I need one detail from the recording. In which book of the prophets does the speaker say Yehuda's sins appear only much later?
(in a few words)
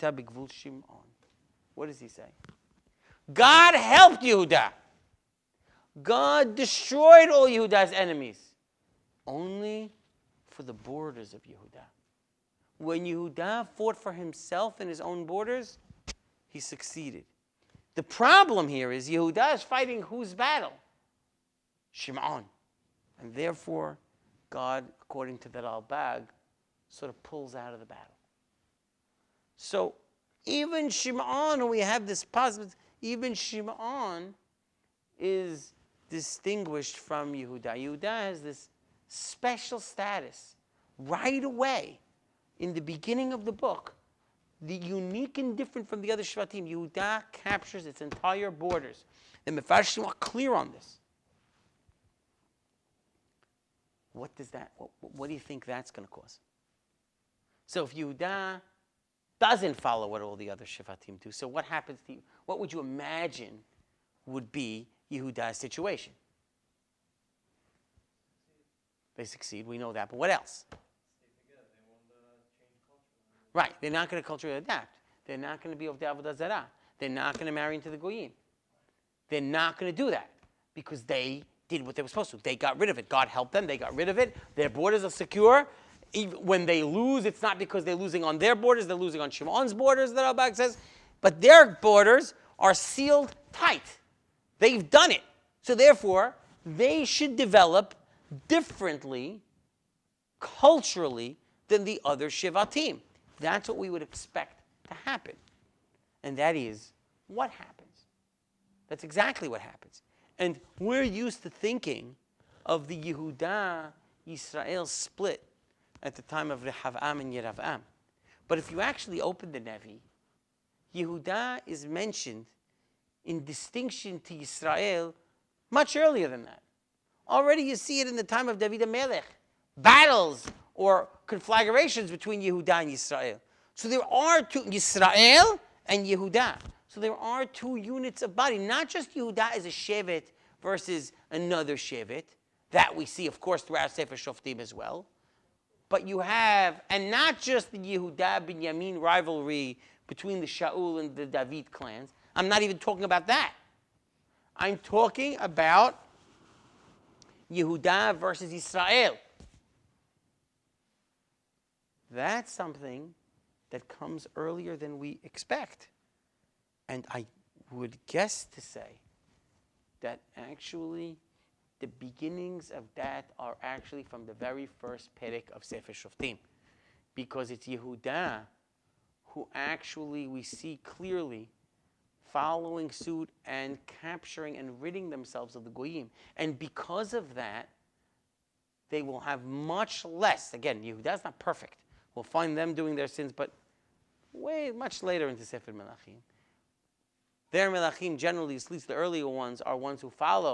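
Sefer Melachim.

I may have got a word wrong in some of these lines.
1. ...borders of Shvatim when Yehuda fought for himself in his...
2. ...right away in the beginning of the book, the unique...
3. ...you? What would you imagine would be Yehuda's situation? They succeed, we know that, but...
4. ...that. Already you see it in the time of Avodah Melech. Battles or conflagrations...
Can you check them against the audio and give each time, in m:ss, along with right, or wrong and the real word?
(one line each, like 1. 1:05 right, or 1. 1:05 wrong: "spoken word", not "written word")
1. 0:10 wrong: "Yehuda", not "Shvatim"
2. 0:40 right
3. 1:02 right
4. 2:06 wrong: "David", not "Avodah".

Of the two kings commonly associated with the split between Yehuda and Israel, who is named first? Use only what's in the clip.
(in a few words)
Rehavam.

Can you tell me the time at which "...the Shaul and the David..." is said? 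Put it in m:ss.
2:30.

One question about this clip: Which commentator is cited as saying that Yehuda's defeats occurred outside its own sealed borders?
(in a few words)
Radak.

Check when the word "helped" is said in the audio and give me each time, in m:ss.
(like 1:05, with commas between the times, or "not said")
0:03, 1:23.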